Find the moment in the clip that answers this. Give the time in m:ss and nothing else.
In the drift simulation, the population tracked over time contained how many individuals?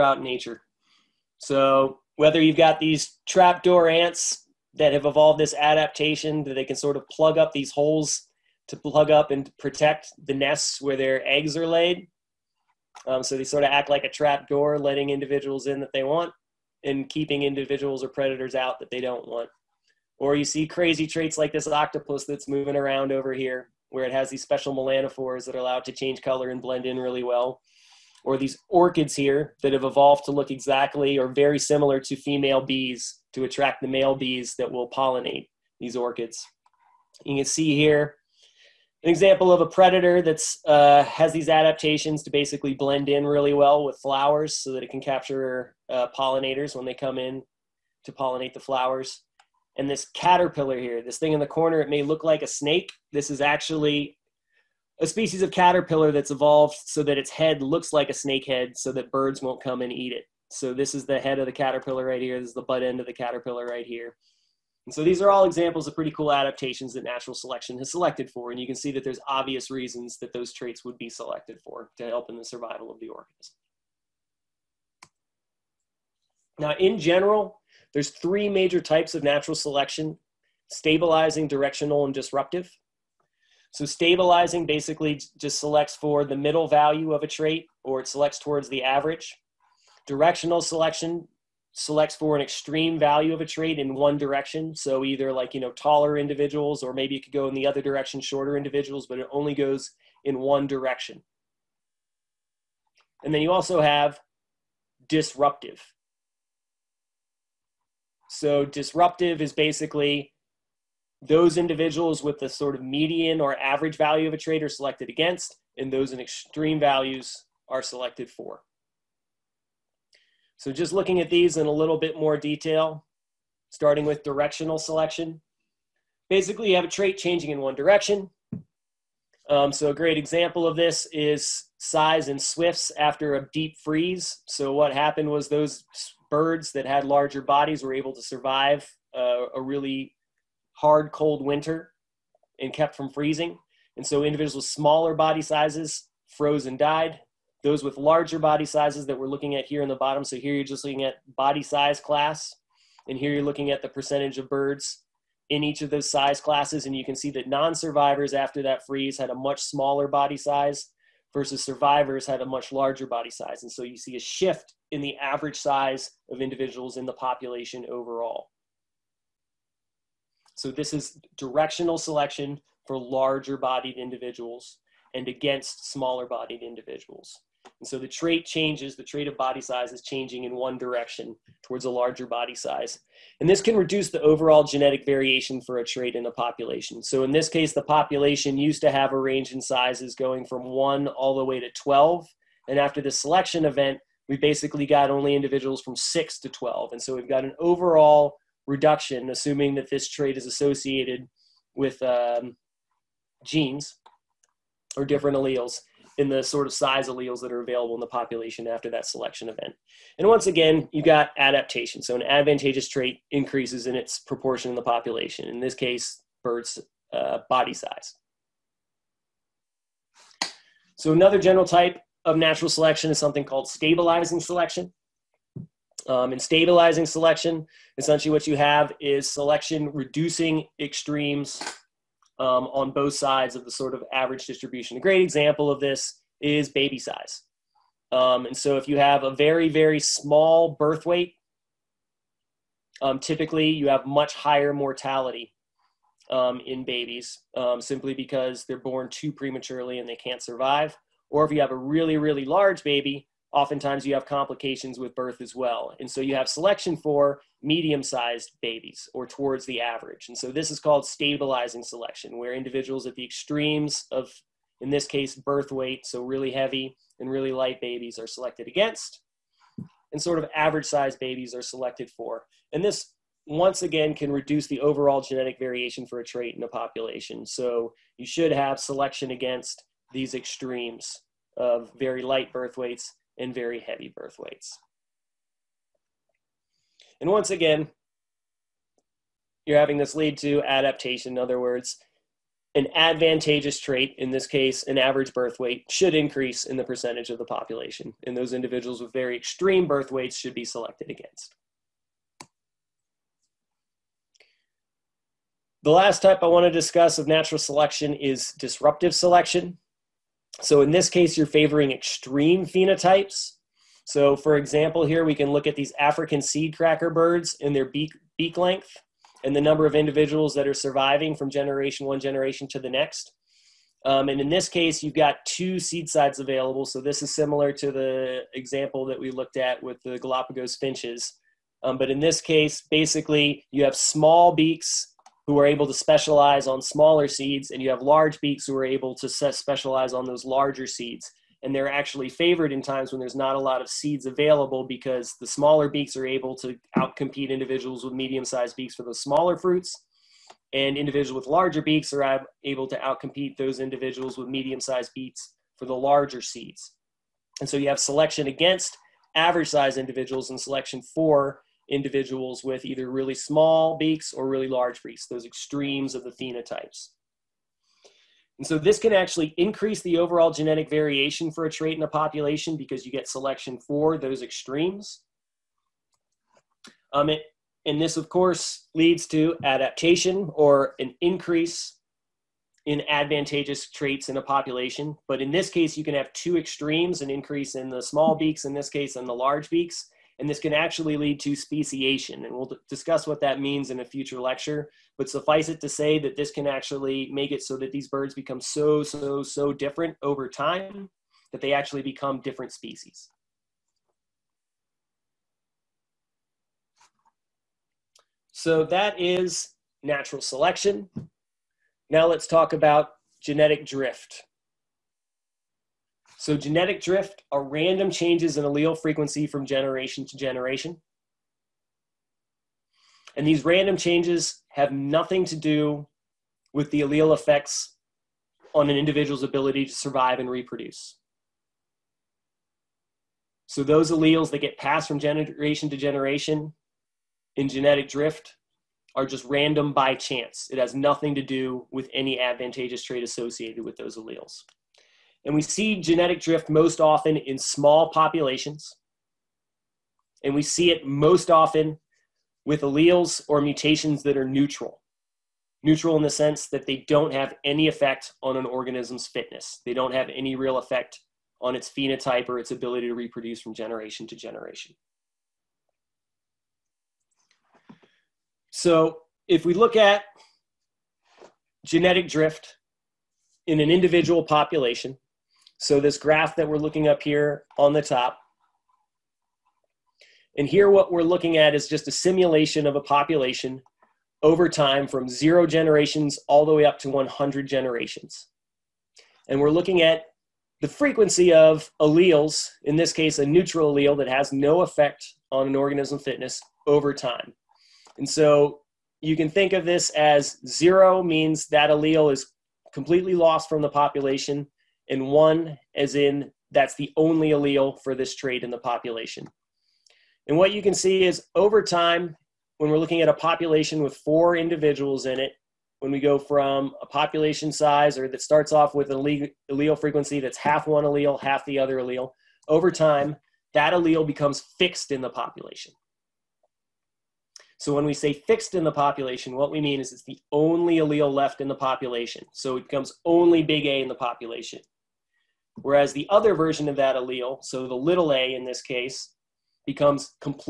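8:34.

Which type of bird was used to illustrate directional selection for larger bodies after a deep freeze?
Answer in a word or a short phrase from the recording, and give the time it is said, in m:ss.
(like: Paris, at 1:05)
swifts, at 2:12.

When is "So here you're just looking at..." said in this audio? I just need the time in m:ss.
2:30.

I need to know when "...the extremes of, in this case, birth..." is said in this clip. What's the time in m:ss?
4:23.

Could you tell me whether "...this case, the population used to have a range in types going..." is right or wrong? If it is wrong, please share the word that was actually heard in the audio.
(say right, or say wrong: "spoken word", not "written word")
wrong: "sizes", not "types".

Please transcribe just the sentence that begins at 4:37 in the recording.
So you should have selection against these extremes of very light birth weights and very heavy birth weights.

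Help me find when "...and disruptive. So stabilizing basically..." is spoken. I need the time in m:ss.
1:22.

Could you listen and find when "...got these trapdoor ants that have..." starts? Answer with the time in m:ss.
0:02.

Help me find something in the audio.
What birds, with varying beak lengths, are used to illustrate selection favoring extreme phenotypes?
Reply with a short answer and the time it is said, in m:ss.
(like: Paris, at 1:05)
African seed cracker birds, at 5:15.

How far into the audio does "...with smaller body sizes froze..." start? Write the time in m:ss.
2:24.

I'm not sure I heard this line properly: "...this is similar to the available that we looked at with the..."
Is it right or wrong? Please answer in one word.
wrong.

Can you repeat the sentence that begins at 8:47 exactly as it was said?
So when we say fixed in the population, what we mean is it's the only allele left in the population.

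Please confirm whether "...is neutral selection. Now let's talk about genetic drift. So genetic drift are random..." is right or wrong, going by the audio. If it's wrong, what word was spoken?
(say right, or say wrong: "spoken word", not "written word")
wrong: "natural", not "neutral".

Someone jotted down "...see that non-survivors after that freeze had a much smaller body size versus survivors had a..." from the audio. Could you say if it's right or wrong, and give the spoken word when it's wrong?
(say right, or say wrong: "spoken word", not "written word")
right.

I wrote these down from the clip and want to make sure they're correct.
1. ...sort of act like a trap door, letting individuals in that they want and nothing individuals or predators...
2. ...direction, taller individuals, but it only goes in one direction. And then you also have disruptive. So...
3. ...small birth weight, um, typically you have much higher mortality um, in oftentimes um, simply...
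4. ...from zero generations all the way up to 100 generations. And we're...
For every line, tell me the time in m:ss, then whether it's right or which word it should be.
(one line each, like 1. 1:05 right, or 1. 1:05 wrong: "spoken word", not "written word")
1. 0:13 wrong: "keeping", not "nothing"
2. 1:37 wrong: "shorter", not "taller"
3. 3:59 wrong: "babies", not "oftentimes"
4. 8:05 right.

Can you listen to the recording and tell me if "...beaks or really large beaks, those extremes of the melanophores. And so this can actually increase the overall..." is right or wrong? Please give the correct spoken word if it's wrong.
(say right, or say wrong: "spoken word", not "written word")
wrong: "phenotypes", not "melanophores".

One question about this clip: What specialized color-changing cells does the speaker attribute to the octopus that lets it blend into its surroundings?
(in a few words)
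melanophores.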